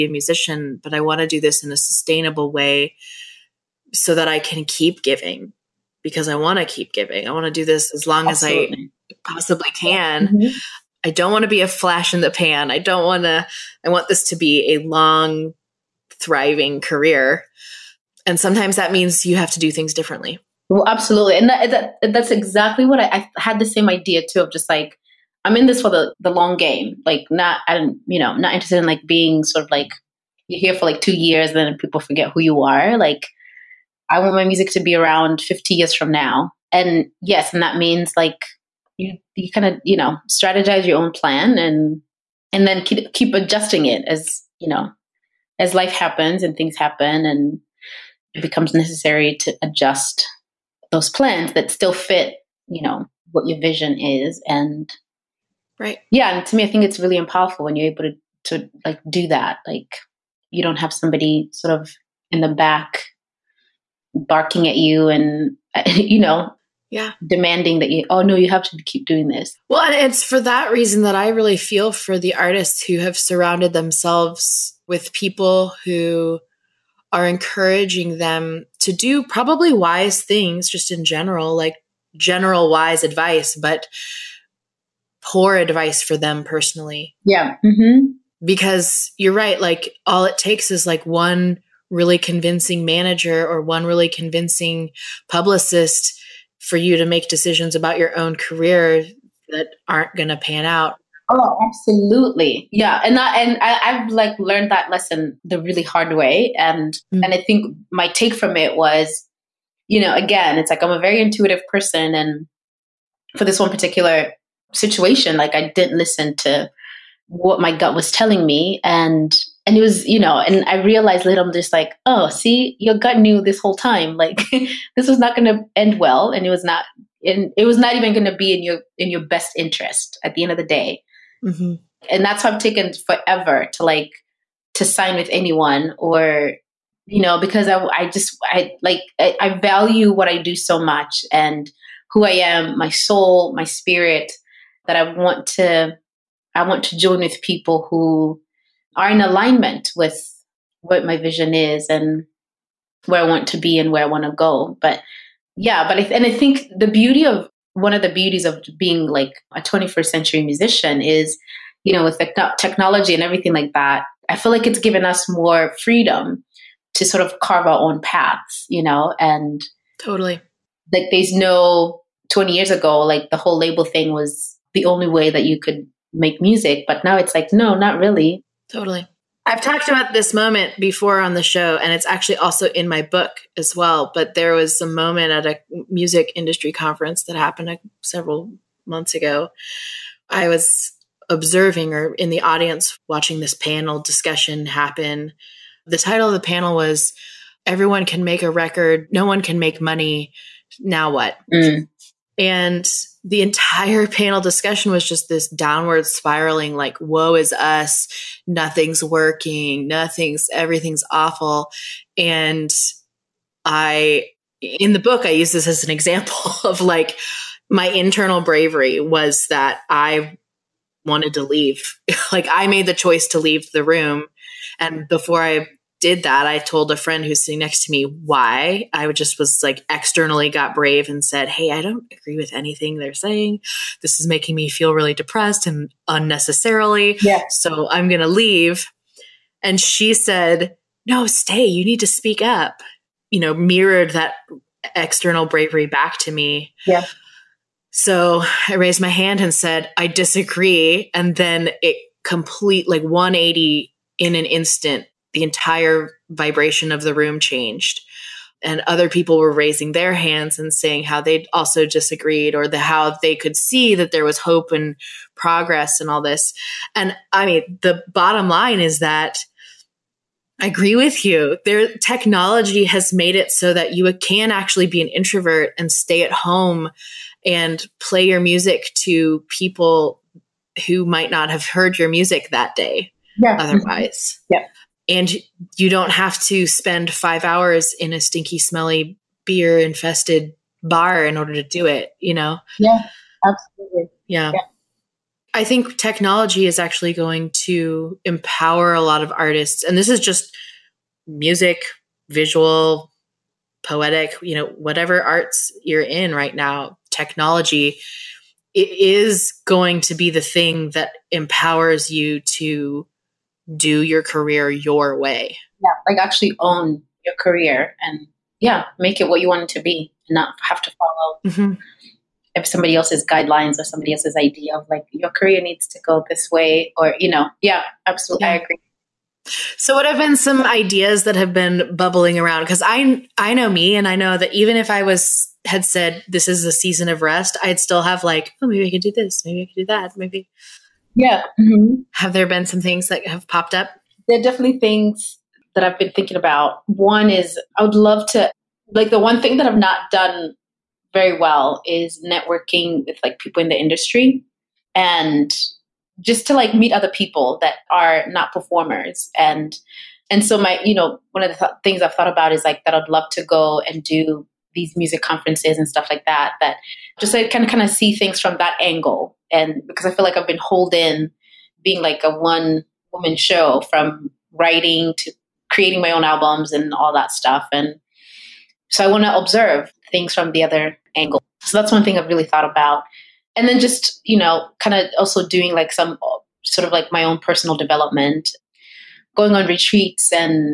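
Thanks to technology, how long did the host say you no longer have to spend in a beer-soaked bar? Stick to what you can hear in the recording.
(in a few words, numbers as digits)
5 hours.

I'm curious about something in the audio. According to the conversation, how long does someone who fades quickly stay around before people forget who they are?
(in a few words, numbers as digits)
2 years.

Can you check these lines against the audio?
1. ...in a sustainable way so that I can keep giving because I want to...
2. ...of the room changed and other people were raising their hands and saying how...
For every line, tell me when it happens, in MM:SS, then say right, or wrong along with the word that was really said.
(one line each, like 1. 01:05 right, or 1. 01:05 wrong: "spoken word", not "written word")
1. 00:01 right
2. 04:16 right.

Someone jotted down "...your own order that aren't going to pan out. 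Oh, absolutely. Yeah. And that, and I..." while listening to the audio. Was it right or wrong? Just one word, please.
wrong.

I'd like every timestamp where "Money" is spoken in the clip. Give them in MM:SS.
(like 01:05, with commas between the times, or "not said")
03:19.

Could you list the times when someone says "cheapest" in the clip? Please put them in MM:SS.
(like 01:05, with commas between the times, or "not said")
not said.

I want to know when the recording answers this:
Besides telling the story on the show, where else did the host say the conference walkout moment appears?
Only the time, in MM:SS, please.
03:02.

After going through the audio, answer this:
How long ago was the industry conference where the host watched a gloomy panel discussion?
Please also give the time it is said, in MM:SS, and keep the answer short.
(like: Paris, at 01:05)
several months ago, at 03:08.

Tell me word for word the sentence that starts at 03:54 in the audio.
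This is making me feel really depressed and unnecessarily.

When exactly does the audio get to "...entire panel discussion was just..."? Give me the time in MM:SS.
03:23.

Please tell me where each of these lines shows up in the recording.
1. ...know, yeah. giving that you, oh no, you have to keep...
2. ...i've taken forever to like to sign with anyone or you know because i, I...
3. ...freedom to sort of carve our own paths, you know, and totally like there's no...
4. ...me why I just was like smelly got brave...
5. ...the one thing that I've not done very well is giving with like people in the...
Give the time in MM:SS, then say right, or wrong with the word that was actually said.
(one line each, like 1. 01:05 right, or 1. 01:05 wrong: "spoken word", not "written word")
1. 01:06 wrong: "demanding", not "giving"
2. 02:12 right
3. 02:45 right
4. 03:47 wrong: "externally", not "smelly"
5. 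05:49 wrong: "networking", not "giving".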